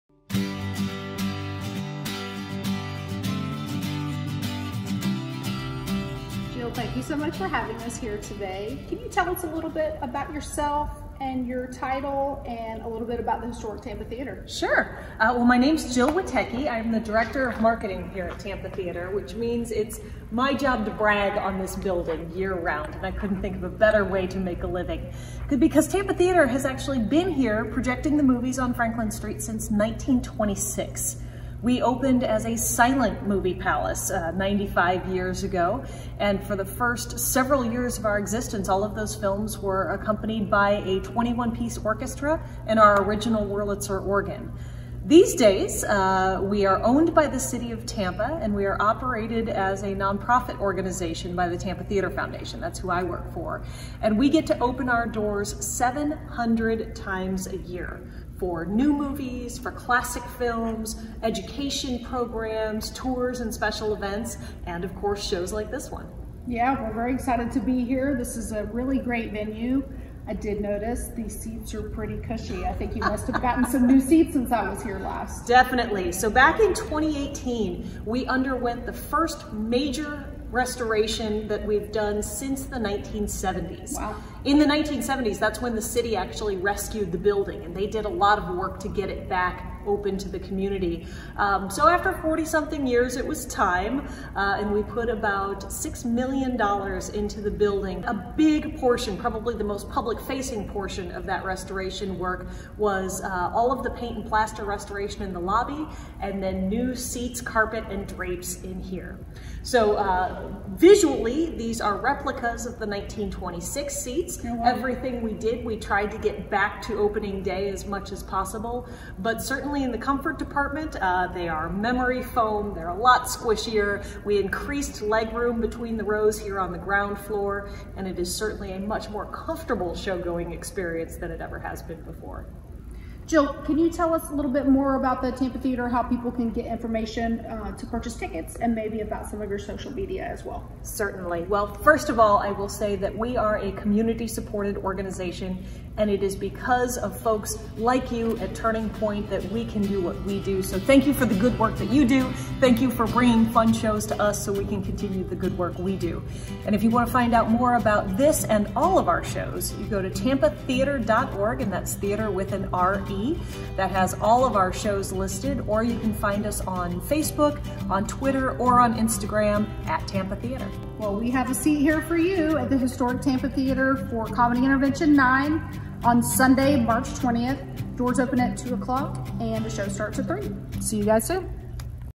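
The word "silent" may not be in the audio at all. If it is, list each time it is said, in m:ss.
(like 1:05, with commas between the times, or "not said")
0:32.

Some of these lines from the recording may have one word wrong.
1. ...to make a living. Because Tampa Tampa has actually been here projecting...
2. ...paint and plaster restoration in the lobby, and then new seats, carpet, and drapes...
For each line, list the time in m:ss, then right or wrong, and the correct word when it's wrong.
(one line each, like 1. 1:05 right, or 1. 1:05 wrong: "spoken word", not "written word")
1. 0:24 wrong: "Theatre", not "Tampa"
2. 1:43 right.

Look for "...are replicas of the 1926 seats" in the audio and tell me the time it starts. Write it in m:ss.
1:51.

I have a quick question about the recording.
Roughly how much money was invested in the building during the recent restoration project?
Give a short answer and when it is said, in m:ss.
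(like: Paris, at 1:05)
$6 million, at 1:35.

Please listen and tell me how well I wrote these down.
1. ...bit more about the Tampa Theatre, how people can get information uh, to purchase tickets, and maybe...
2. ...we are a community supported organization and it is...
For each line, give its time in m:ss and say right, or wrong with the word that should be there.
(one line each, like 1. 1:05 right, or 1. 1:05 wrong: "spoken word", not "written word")
1. 2:14 right
2. 2:23 right.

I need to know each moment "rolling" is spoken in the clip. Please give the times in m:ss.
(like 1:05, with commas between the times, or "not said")
not said.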